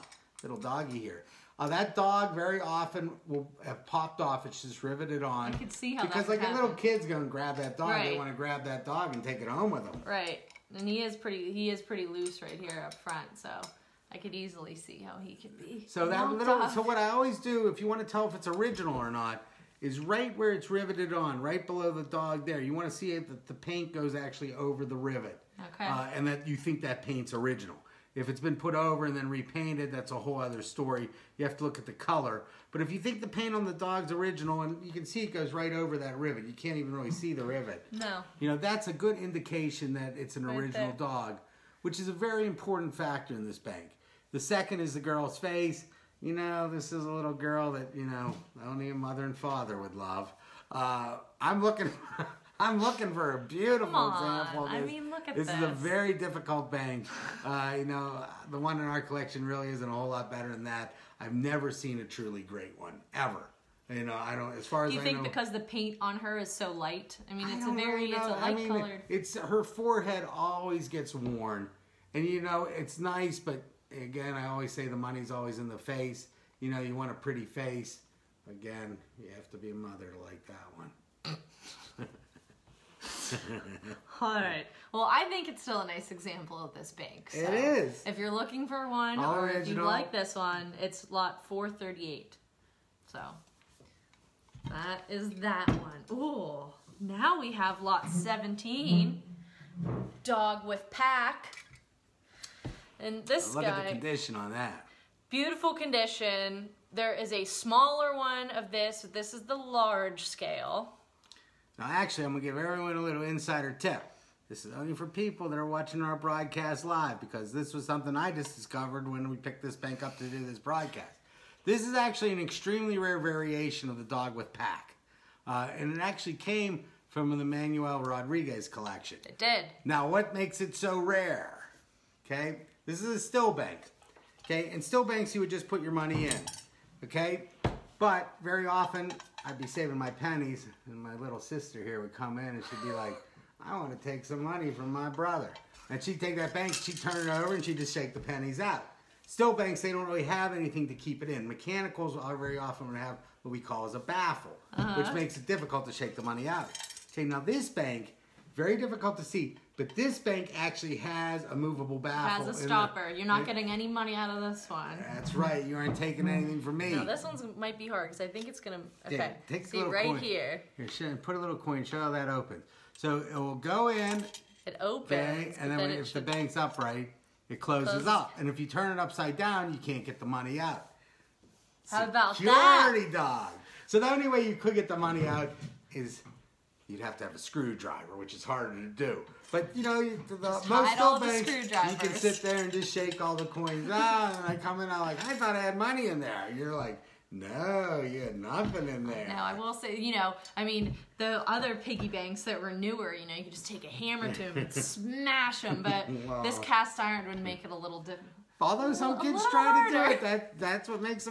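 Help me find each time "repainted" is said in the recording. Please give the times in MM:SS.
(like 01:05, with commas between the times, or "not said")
00:29.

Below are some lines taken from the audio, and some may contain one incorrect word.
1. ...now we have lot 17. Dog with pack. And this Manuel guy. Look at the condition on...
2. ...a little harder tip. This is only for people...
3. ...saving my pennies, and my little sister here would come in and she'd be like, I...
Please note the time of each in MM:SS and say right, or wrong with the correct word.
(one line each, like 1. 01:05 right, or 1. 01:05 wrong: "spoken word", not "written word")
1. 01:36 wrong: "Look", not "Manuel"
2. 01:52 wrong: "insider", not "harder"
3. 02:19 right.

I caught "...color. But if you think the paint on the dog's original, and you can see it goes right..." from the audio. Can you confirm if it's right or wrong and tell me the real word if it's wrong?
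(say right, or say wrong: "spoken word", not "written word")
right.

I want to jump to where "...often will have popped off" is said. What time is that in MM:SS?
00:02.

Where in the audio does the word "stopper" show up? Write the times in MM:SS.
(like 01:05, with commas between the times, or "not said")
02:42.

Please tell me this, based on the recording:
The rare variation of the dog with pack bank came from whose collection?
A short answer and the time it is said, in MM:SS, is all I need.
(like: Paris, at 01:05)
Manuel Rodriguez, at 02:07.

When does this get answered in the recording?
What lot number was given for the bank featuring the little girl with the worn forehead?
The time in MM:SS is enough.
01:31.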